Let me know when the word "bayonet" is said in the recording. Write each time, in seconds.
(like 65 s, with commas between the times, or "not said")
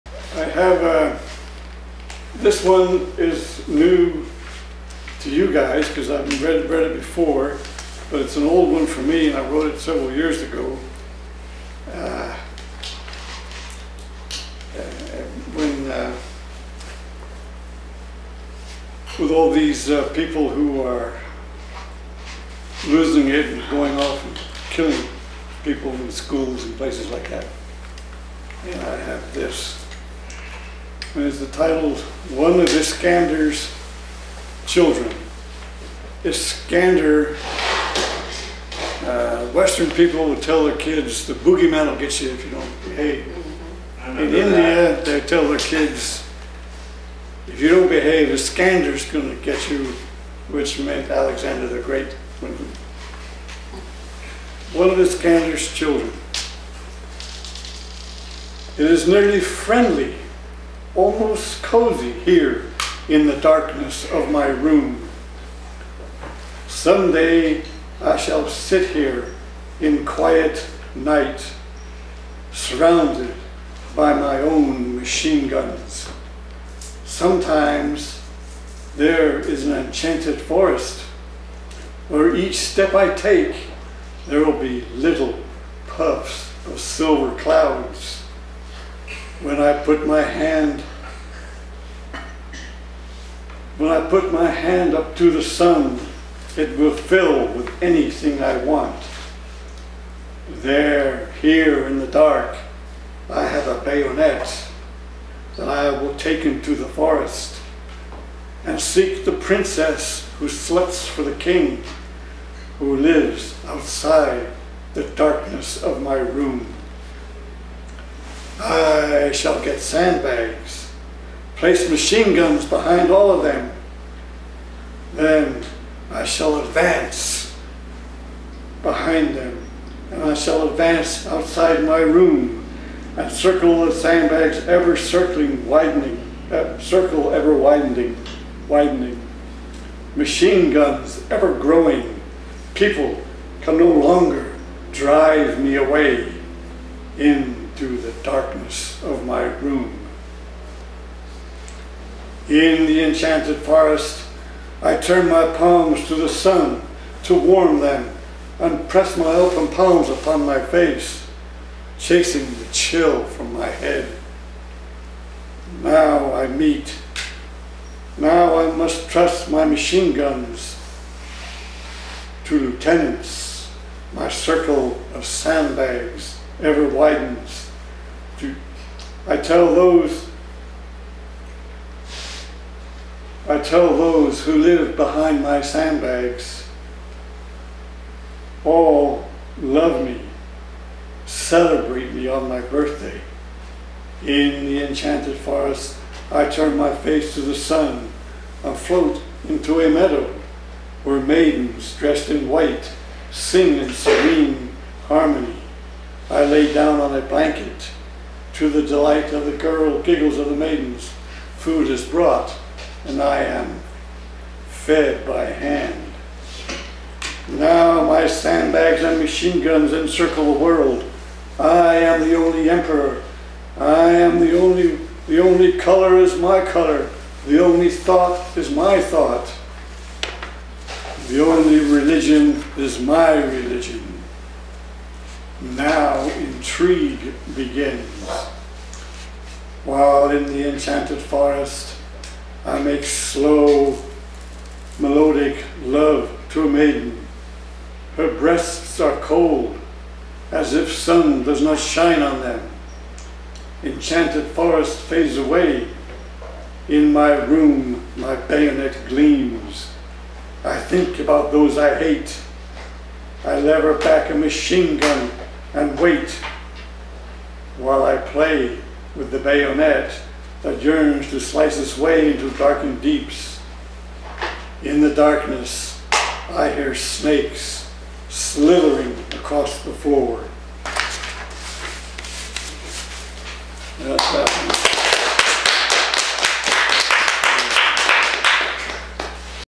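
103 s, 258 s, 269 s.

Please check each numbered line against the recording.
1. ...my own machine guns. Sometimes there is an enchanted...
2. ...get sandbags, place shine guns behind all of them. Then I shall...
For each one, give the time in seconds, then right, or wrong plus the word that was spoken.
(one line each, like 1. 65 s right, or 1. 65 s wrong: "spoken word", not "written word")
1. 74 s right
2. 119 s wrong: "machine", not "shine".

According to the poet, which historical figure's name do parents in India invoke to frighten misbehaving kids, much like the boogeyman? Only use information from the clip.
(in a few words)
Alexander the Great.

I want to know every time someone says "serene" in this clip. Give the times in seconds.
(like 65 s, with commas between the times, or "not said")
203 s.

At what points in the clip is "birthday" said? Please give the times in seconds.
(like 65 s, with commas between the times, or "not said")
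192 s.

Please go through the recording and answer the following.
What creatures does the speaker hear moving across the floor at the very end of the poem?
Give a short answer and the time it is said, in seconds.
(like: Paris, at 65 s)
Snakes, at 276 s.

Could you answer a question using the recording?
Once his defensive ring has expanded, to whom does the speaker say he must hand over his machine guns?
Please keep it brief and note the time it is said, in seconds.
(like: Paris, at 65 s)
Lieutenants, at 172 s.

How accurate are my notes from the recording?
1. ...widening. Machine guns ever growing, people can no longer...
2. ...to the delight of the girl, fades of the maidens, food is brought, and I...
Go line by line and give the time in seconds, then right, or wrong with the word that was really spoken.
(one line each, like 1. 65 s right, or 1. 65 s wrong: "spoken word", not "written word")
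1. 138 s right
2. 208 s wrong: "giggles", not "fades".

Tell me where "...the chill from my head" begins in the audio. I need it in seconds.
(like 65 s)
162 s.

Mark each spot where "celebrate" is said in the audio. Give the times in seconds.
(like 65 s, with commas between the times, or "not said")
191 s.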